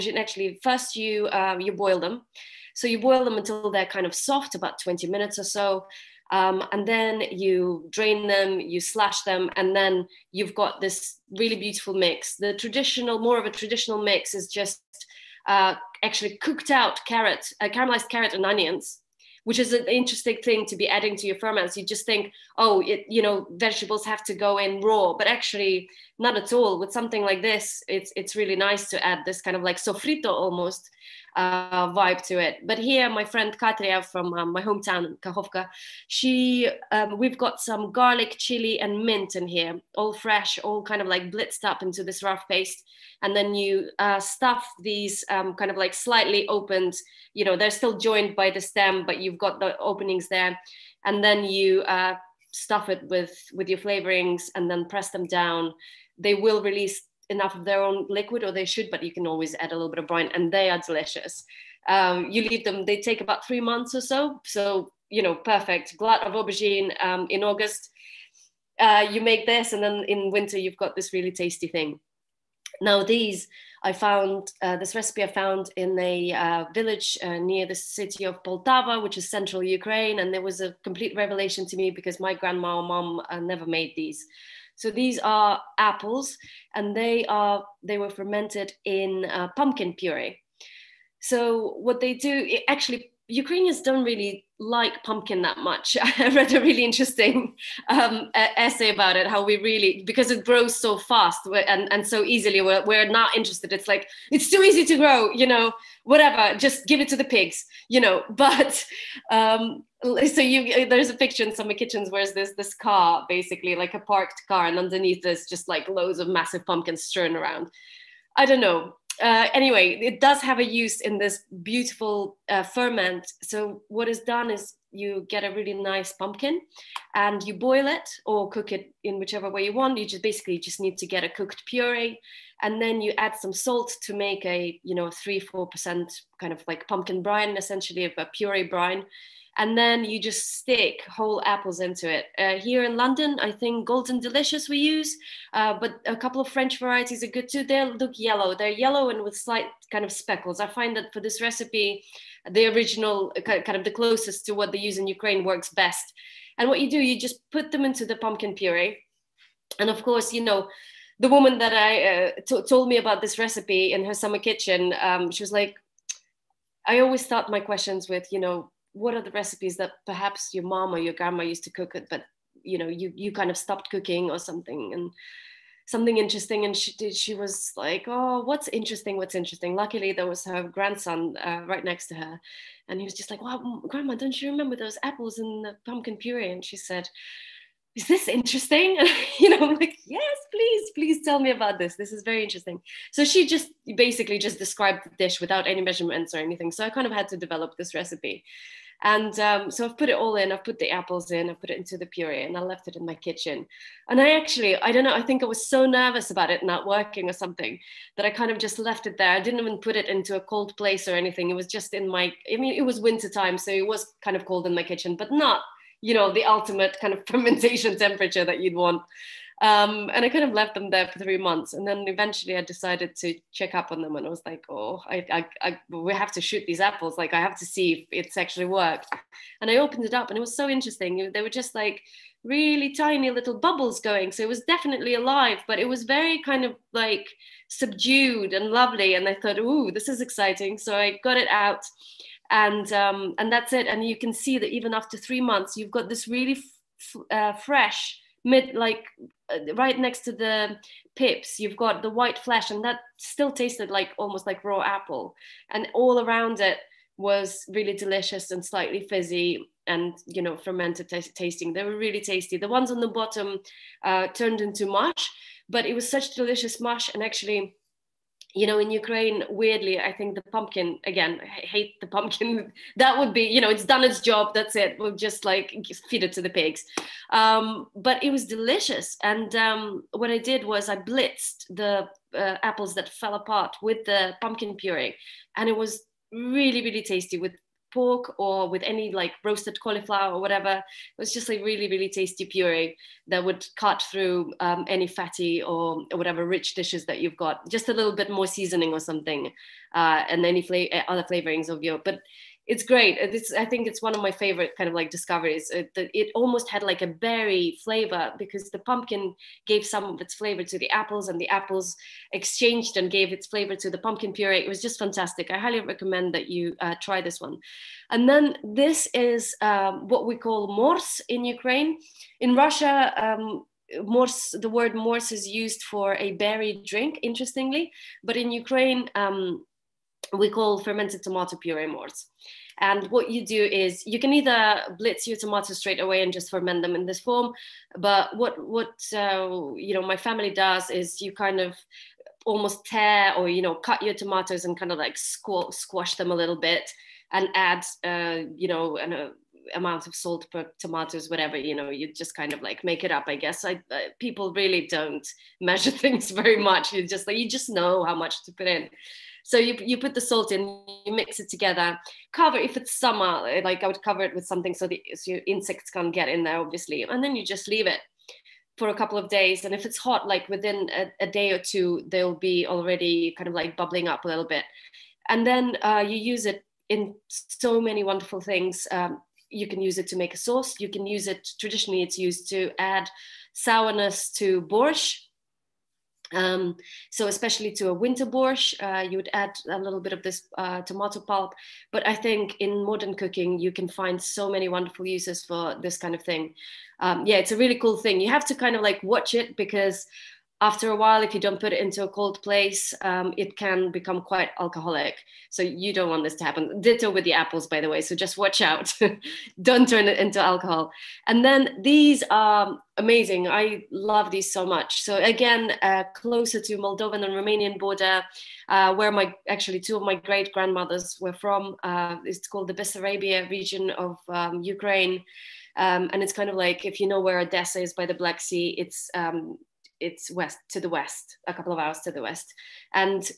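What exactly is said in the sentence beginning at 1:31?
So what they do, it, actually, Ukrainians don't really like pumpkin that much.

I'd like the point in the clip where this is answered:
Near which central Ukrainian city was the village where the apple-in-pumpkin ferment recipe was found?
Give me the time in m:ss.
1:18.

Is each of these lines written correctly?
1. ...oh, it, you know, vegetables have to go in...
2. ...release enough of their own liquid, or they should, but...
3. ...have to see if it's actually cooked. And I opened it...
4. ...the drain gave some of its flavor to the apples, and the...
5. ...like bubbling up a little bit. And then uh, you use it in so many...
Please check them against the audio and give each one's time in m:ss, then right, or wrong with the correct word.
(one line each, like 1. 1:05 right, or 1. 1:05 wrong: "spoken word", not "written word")
1. 0:22 right
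2. 0:56 right
3. 3:47 wrong: "worked", not "cooked"
4. 5:08 wrong: "pumpkin", not "drain"
5. 6:13 right.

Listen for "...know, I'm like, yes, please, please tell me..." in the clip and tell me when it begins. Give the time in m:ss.
3:09.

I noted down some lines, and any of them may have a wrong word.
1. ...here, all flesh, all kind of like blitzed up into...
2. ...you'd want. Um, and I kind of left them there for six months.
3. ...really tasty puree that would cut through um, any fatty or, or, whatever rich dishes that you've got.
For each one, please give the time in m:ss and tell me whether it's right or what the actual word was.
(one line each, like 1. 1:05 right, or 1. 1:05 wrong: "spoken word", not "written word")
1. 0:39 wrong: "fresh", not "flesh"
2. 3:38 wrong: "three", not "six"
3. 4:51 right.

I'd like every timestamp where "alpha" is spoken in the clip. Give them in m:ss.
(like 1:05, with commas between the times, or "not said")
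not said.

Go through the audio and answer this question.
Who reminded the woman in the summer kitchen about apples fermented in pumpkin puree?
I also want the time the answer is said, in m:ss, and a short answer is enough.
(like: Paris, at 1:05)
Her grandson, at 3:00.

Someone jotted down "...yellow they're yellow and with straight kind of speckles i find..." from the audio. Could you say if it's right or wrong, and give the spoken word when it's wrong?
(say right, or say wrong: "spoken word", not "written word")
wrong: "slight", not "straight".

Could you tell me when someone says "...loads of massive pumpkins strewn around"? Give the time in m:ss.
1:55.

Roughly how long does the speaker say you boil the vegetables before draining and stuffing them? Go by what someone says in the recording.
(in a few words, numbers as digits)
20 minutes.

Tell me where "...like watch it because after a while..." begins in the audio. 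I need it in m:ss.
6:38.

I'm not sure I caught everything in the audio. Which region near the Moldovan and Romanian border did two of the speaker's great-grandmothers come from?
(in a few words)
Bessarabia.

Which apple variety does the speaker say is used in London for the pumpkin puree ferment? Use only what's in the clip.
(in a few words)
Golden Delicious.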